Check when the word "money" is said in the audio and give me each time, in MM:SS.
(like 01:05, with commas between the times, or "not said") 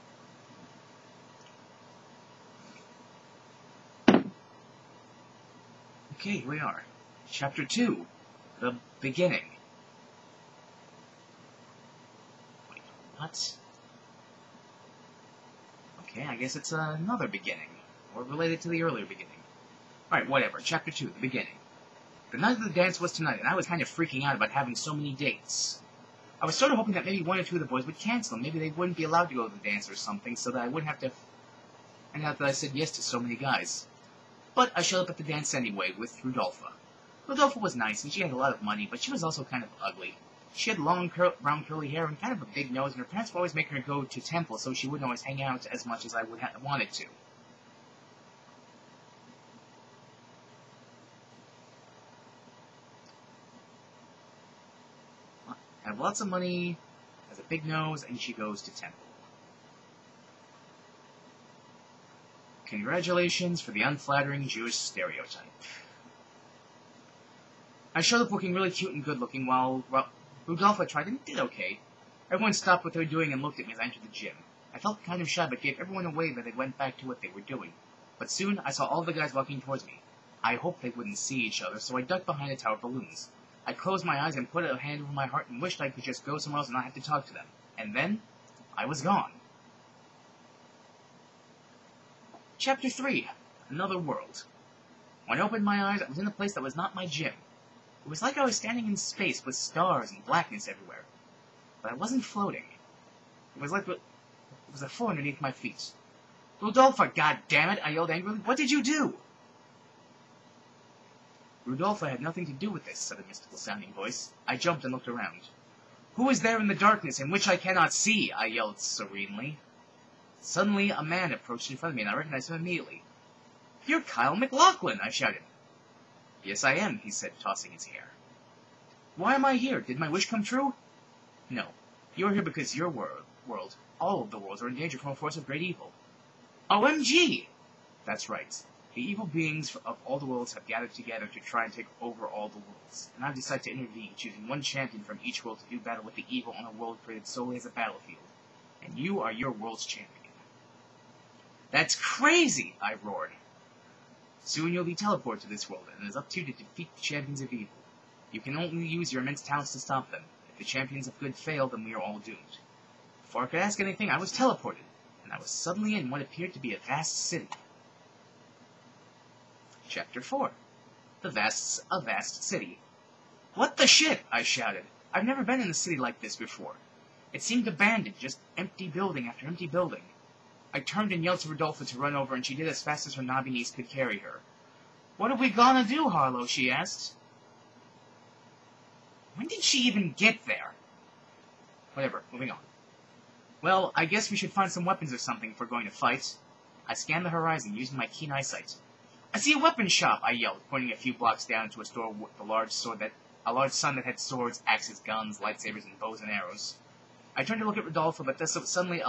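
00:38, 00:56.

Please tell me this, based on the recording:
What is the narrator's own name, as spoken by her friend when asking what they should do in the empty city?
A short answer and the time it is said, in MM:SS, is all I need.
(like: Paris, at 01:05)
Harlow, at 03:06.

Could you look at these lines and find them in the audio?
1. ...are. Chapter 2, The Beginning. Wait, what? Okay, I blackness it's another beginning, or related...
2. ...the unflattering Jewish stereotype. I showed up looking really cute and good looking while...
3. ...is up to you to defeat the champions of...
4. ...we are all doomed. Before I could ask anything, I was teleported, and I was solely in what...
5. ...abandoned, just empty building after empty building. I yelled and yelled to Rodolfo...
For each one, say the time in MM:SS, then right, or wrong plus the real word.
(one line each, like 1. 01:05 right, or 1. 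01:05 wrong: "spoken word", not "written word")
1. 00:06 wrong: "guess", not "blackness"
2. 01:03 right
3. 02:36 right
4. 02:41 wrong: "suddenly", not "solely"
5. 02:57 wrong: "turned", not "yelled".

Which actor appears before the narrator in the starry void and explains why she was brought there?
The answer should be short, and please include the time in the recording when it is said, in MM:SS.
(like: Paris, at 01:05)
Kyle MacLachlan, at 02:04.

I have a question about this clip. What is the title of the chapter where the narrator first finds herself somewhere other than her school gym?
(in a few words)
Another World.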